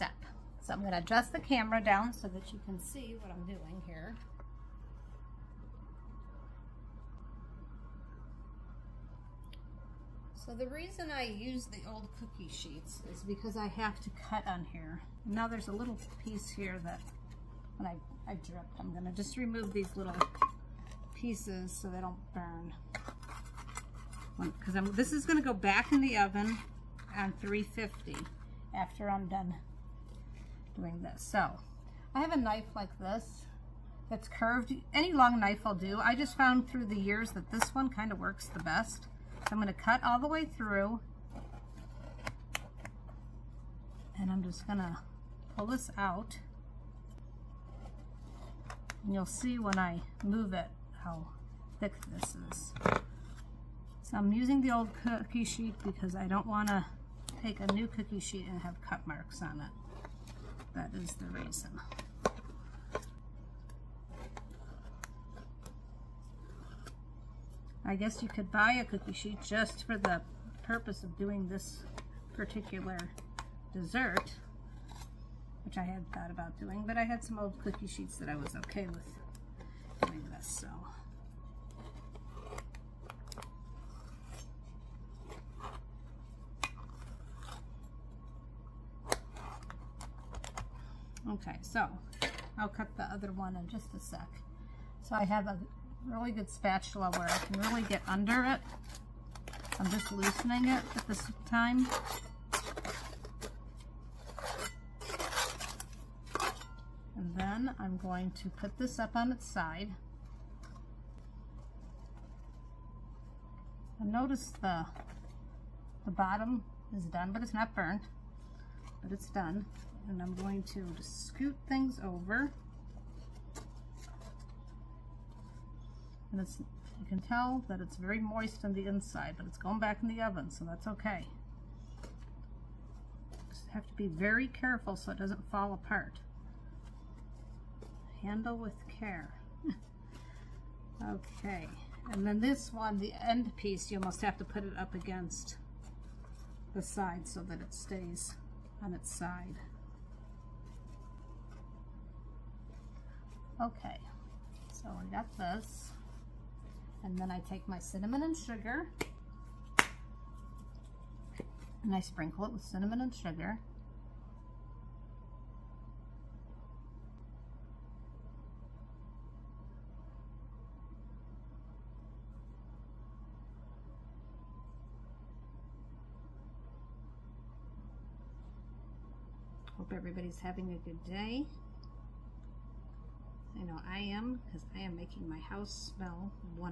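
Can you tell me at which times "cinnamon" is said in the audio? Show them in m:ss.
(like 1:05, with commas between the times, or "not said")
2:37, 2:42.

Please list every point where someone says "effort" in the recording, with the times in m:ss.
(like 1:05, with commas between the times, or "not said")
not said.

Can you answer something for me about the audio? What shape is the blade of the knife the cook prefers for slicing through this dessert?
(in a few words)
curved.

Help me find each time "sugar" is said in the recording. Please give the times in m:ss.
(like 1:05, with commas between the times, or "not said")
2:38, 2:43.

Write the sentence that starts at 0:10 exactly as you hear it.
So the reason I use the old cookie sheets is because I have to cut on here.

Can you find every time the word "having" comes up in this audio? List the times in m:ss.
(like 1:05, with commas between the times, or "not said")
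3:00.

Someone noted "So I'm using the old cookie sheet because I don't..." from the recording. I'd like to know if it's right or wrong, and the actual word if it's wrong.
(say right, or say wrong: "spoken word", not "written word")
right.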